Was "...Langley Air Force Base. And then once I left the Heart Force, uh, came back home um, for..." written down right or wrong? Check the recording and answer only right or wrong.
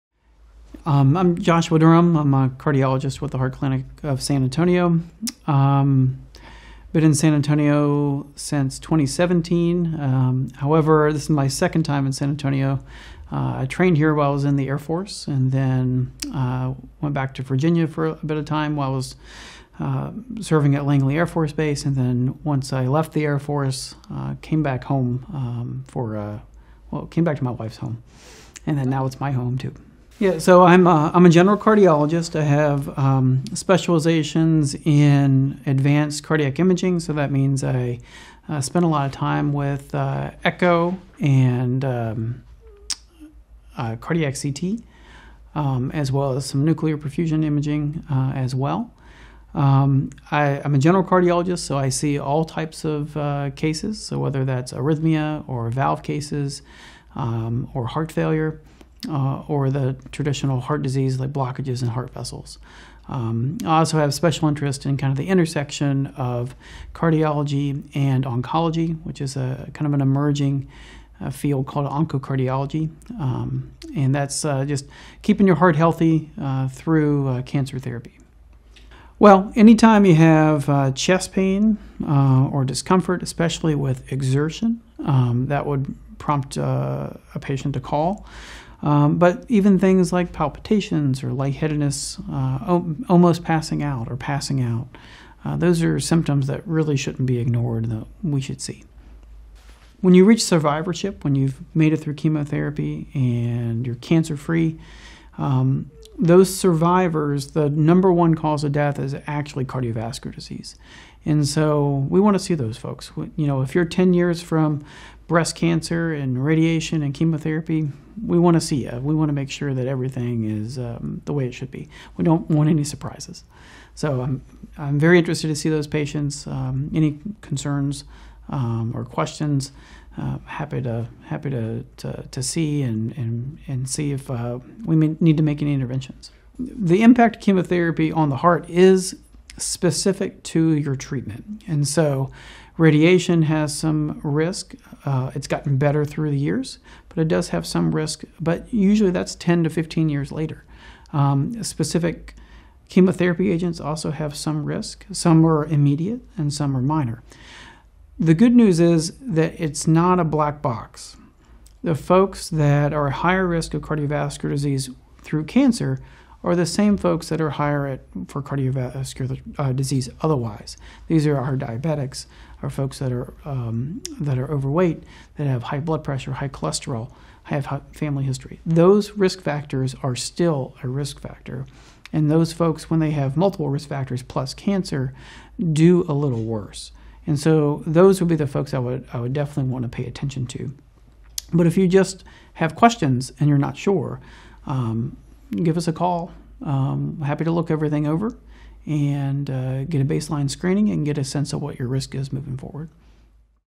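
wrong.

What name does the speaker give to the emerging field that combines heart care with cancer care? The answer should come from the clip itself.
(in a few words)
oncocardiology.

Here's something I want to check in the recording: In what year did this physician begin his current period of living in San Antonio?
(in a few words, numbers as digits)
2017.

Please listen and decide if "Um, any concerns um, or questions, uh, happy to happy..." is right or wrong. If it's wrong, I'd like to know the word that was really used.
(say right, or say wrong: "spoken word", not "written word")
right.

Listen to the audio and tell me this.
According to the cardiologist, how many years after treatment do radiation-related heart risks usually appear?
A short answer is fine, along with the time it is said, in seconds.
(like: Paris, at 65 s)
10 to 15 years, at 149 s.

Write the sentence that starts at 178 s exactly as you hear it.
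Those risk factors are still a risk factor.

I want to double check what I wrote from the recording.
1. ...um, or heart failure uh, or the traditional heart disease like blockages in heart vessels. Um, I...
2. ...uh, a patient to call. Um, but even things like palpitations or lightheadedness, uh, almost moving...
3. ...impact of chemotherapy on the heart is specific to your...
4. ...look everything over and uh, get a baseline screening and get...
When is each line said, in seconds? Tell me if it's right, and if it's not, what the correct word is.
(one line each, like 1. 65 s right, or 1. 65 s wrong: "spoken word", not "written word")
1. 57 s right
2. 86 s wrong: "passing", not "moving"
3. 137 s right
4. 197 s right.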